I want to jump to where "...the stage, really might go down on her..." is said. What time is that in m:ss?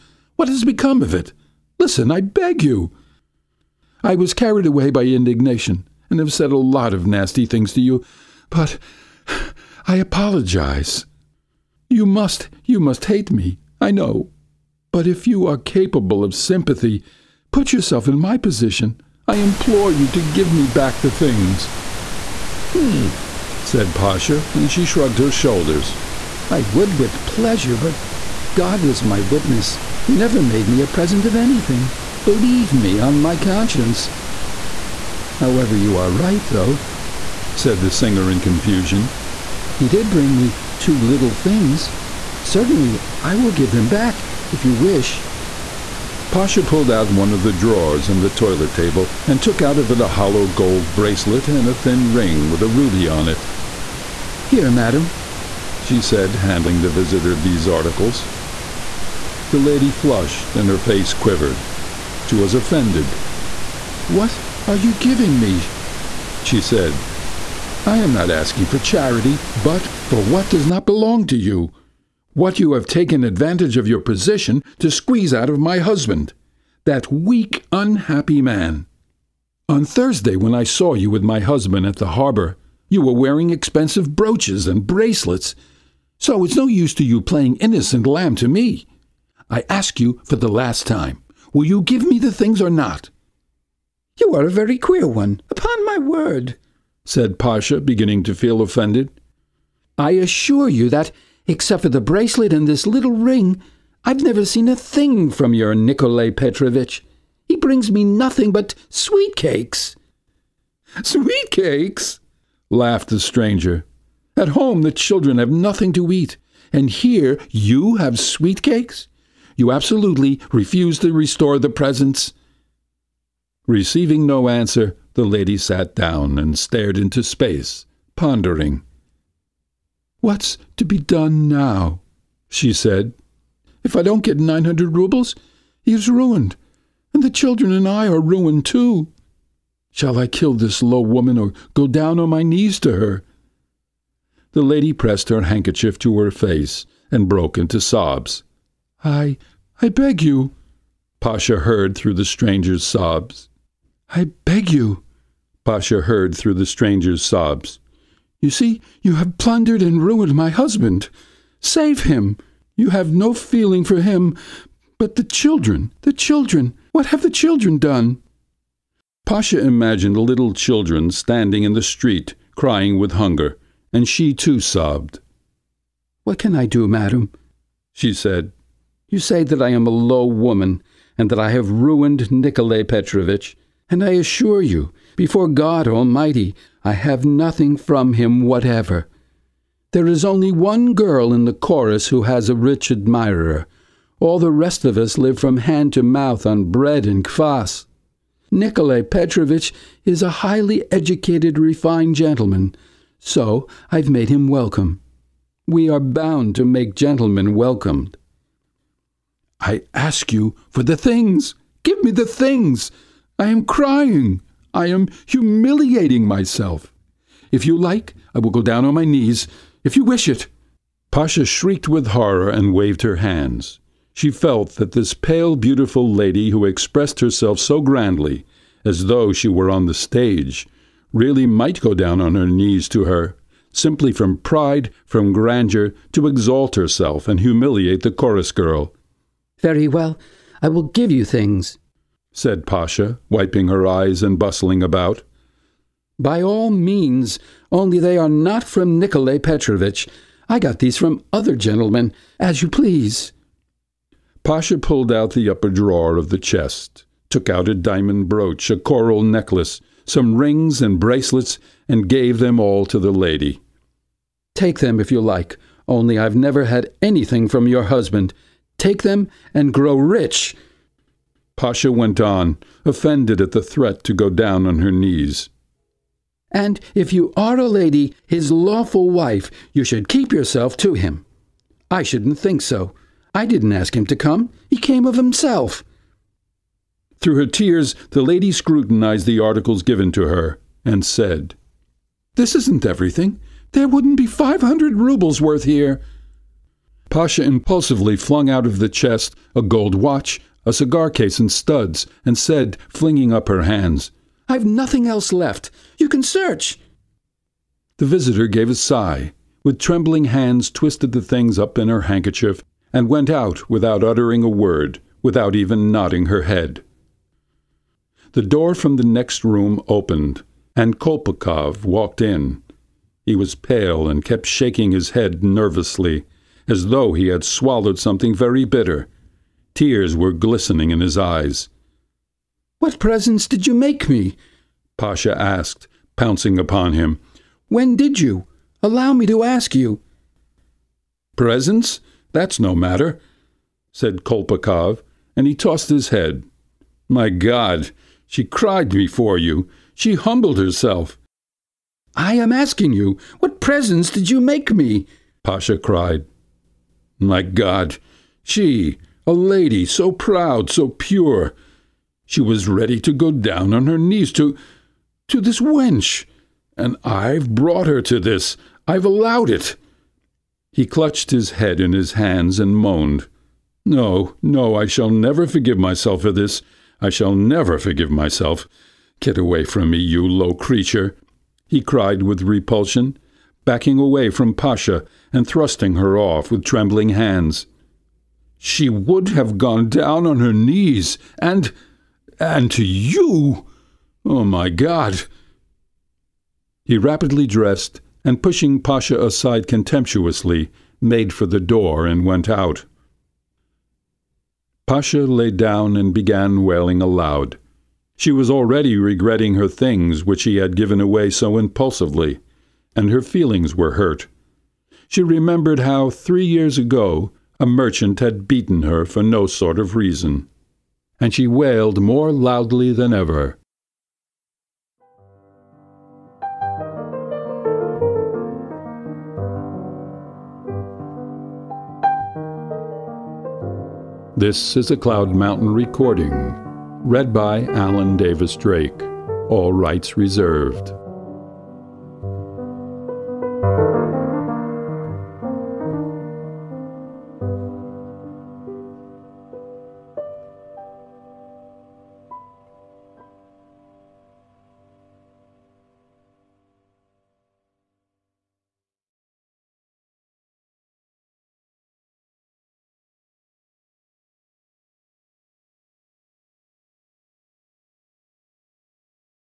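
3:49.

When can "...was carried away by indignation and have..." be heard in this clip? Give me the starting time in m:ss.
0:04.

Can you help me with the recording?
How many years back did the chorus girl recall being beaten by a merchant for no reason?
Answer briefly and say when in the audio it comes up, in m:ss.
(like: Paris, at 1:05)
3, at 6:56.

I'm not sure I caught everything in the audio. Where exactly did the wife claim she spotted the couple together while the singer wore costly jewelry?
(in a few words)
the harbor.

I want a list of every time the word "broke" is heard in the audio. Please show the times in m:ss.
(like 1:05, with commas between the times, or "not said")
2:27.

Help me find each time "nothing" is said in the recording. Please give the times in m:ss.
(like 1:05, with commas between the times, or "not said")
1:48, 1:55, 3:07, 5:04.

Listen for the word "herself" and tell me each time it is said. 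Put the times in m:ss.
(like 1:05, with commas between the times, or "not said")
3:47, 3:56, 5:50.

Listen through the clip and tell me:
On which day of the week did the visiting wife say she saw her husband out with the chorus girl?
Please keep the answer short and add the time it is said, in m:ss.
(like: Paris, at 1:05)
Thursday, at 1:19.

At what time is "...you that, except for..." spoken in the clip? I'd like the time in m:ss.
1:40.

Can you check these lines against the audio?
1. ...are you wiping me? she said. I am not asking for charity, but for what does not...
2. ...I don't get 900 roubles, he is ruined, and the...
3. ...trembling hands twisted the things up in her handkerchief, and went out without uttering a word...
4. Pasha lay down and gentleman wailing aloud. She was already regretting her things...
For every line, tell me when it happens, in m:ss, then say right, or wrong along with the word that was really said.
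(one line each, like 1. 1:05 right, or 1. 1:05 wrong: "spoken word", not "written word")
1. 1:04 wrong: "giving", not "wiping"
2. 2:13 right
3. 5:09 right
4. 6:44 wrong: "began", not "gentleman".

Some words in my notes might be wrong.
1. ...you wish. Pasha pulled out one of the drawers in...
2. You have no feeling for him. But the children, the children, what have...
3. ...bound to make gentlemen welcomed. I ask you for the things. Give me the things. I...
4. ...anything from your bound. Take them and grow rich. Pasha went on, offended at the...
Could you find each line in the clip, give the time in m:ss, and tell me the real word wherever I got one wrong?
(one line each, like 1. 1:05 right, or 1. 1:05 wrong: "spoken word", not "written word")
1. 0:44 right
2. 2:42 right
3. 3:25 right
4. 4:27 wrong: "husband", not "bound".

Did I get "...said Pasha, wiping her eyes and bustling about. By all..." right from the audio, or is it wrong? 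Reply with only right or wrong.
right.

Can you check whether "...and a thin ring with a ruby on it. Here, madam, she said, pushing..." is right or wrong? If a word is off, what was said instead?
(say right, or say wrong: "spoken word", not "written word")
wrong: "handing", not "pushing".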